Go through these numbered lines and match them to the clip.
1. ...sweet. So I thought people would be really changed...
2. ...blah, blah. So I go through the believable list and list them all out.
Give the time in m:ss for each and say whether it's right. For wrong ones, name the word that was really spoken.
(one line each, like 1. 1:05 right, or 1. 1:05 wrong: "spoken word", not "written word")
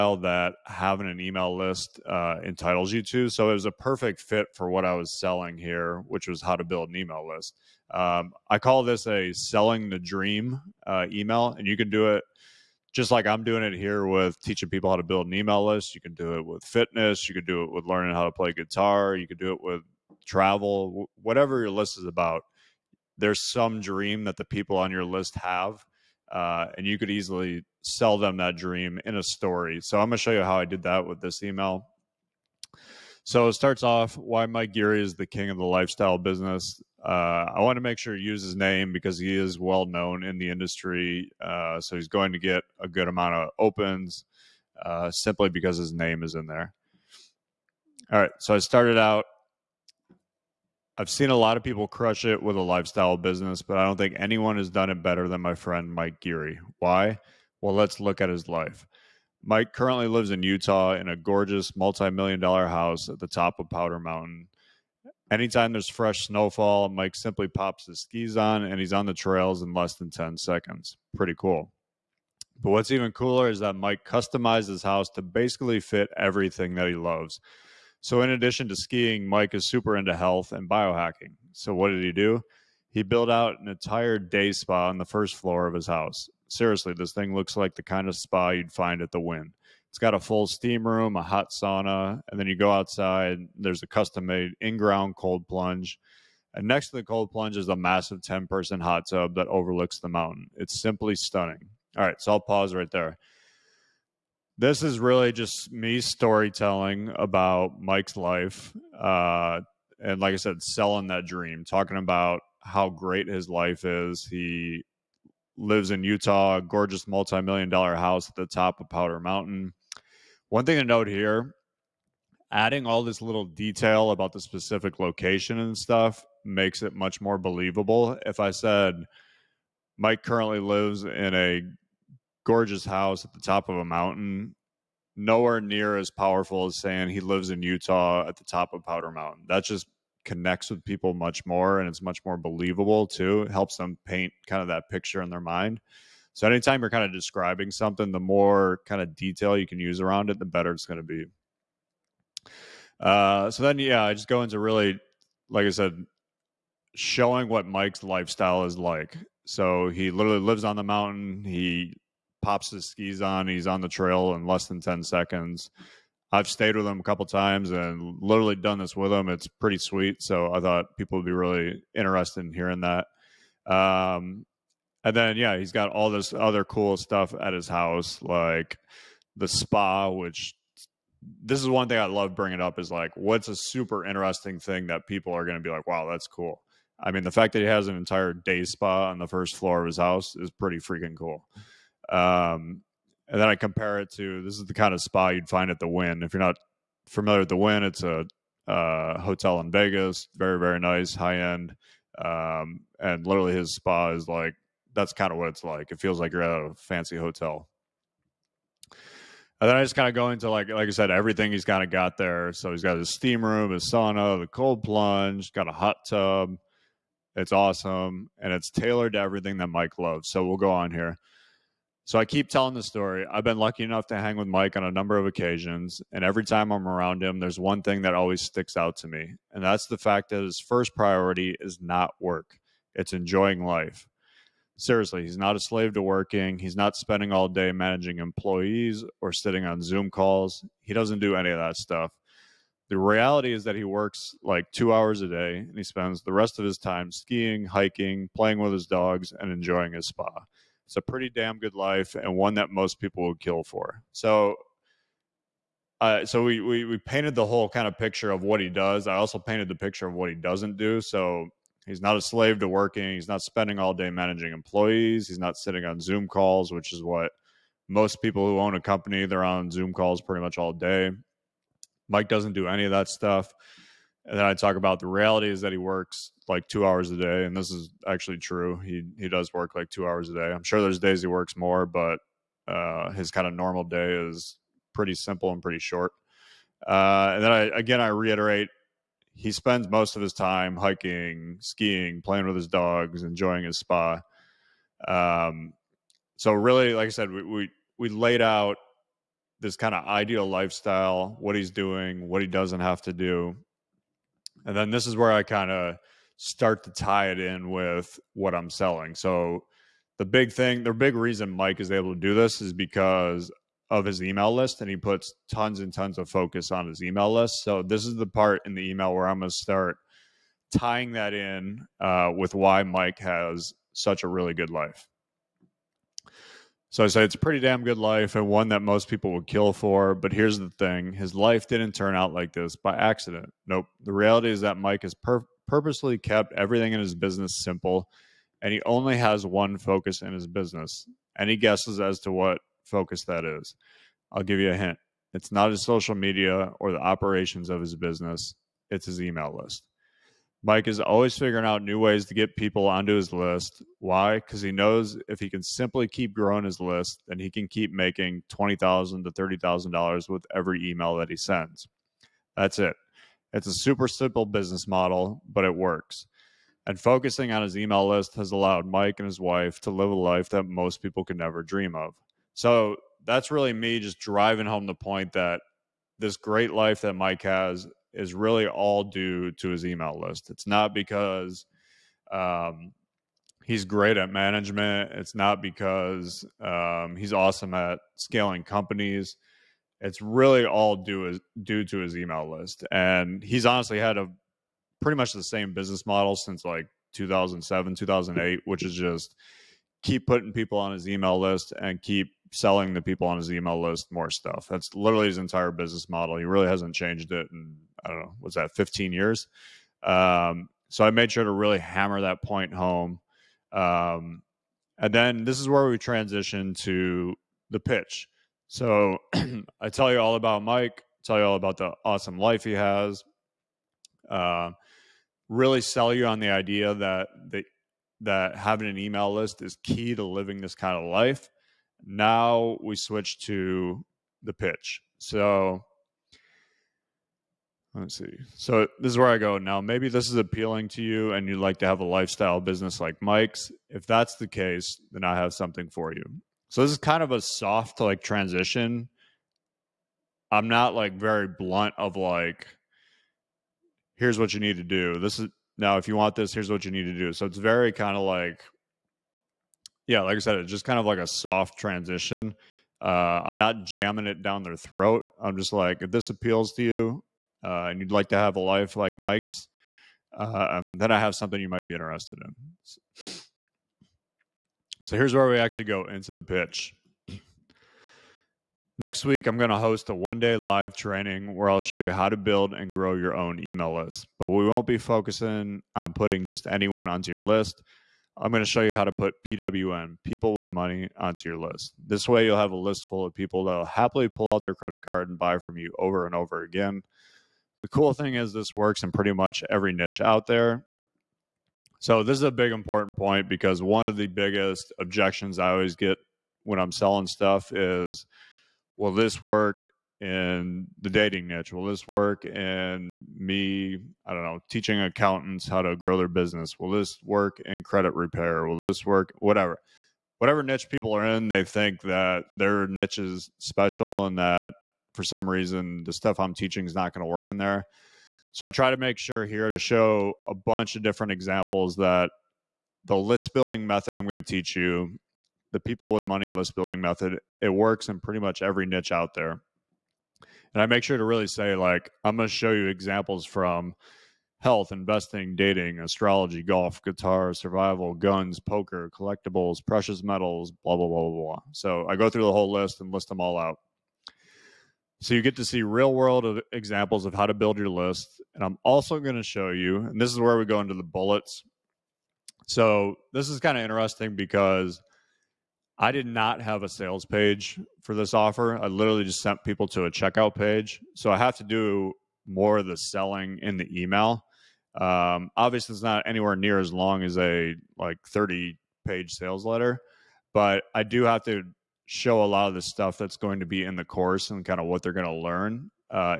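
1. 2:49 wrong: "interested", not "changed"
2. 9:11 wrong: "whole", not "believable".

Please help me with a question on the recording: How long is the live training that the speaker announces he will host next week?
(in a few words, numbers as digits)
one day.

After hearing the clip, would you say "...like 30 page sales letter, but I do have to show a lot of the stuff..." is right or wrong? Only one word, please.
right.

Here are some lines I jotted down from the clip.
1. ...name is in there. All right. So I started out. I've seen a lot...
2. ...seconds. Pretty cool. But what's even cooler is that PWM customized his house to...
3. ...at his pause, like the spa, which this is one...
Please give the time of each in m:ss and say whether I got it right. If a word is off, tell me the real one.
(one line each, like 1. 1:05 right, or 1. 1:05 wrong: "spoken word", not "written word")
1. 0:45 right
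2. 1:10 wrong: "Mike", not "PWM"
3. 2:57 wrong: "house", not "pause".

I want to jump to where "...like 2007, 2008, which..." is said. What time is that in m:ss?
6:36.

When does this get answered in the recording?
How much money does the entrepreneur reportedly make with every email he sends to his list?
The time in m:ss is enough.
5:58.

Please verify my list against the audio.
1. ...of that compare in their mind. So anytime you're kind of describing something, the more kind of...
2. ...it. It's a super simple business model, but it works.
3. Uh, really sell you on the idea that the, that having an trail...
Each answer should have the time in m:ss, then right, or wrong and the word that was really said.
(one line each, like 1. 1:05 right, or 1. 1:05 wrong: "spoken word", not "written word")
1. 2:24 wrong: "picture", not "compare"
2. 6:02 right
3. 7:04 wrong: "email", not "trail".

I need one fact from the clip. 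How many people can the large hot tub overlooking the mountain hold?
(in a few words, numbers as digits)
10.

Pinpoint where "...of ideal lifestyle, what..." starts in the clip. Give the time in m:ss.
4:59.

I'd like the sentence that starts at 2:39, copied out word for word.
So he literally lives on the mountain.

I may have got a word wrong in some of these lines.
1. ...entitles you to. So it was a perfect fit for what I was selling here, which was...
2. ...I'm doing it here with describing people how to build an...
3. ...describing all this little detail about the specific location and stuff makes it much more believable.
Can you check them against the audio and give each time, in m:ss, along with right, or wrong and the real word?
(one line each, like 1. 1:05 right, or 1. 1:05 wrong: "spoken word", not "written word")
1. 0:02 right
2. 0:13 wrong: "teaching", not "describing"
3. 2:02 wrong: "adding", not "describing".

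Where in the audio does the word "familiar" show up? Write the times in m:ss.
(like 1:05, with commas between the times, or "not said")
3:17.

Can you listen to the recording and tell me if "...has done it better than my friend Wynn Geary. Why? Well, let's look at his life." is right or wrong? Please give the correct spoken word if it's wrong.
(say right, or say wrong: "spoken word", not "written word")
wrong: "Mike", not "Wynn".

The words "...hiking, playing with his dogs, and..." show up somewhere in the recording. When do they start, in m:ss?
4:07.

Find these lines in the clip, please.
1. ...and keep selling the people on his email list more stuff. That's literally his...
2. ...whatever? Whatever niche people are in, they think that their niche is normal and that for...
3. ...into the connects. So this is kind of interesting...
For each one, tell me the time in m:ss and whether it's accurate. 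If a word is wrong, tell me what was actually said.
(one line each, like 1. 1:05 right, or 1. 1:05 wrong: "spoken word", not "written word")
1. 6:41 right
2. 8:39 wrong: "special", not "normal"
3. 9:20 wrong: "bullets", not "connects".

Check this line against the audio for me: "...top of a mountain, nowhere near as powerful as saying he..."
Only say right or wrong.
right.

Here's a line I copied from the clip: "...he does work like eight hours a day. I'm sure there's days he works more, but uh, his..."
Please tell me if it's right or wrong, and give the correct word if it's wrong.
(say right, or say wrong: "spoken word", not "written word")
wrong: "two", not "eight".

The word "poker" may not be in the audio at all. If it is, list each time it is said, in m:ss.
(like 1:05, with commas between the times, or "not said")
9:08.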